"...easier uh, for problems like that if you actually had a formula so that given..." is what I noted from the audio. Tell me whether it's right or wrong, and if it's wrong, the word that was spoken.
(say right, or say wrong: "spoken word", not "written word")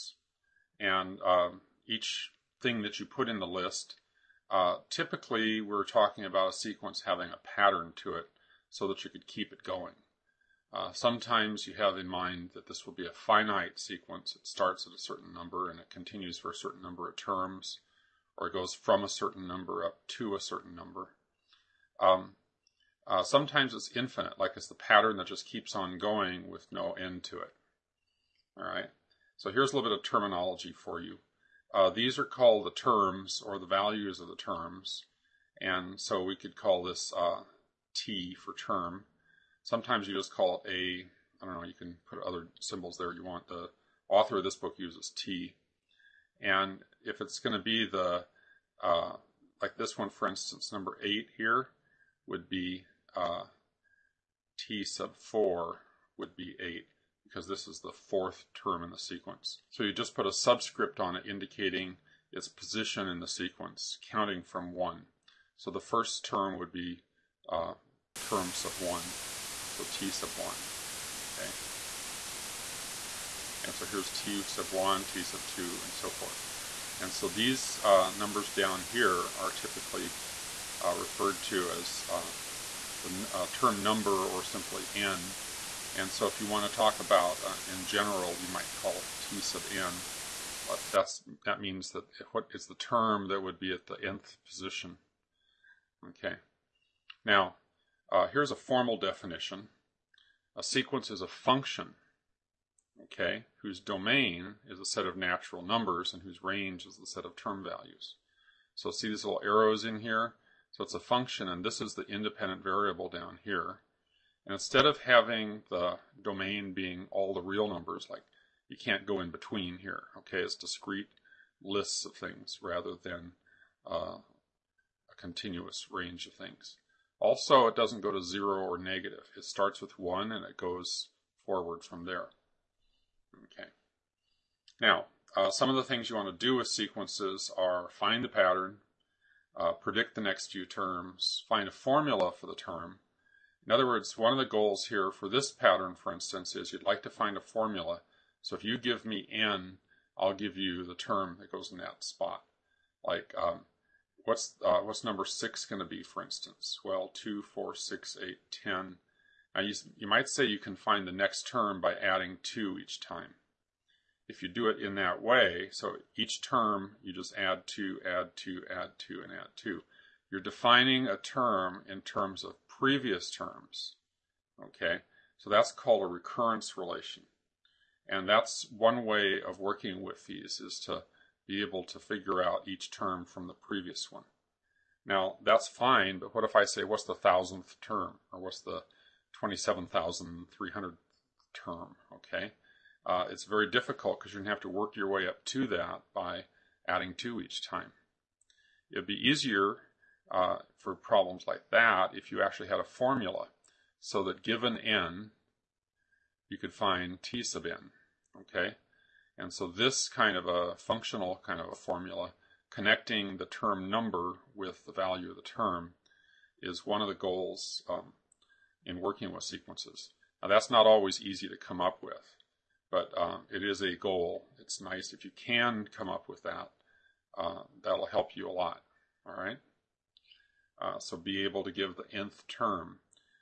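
right.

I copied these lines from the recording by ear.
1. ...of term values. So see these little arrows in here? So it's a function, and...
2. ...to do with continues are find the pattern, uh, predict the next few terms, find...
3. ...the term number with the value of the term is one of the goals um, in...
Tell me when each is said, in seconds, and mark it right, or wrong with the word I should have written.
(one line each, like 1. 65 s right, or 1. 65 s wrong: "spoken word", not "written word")
1. 107 s right
2. 136 s wrong: "sequences", not "continues"
3. 213 s right.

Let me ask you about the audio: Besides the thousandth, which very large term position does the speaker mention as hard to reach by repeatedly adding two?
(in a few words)
27,300.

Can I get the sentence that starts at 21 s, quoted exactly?
Um, uh, sometimes it's infinite, like it's the pattern that just keeps on going with no end to it.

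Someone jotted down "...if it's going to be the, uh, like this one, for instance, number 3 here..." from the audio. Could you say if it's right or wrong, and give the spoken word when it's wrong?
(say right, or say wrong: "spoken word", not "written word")
wrong: "8", not "3".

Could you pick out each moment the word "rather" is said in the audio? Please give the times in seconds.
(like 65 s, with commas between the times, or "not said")
122 s.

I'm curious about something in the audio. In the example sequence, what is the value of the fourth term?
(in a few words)
8.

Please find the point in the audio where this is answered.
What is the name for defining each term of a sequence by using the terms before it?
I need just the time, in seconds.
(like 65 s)
176 s.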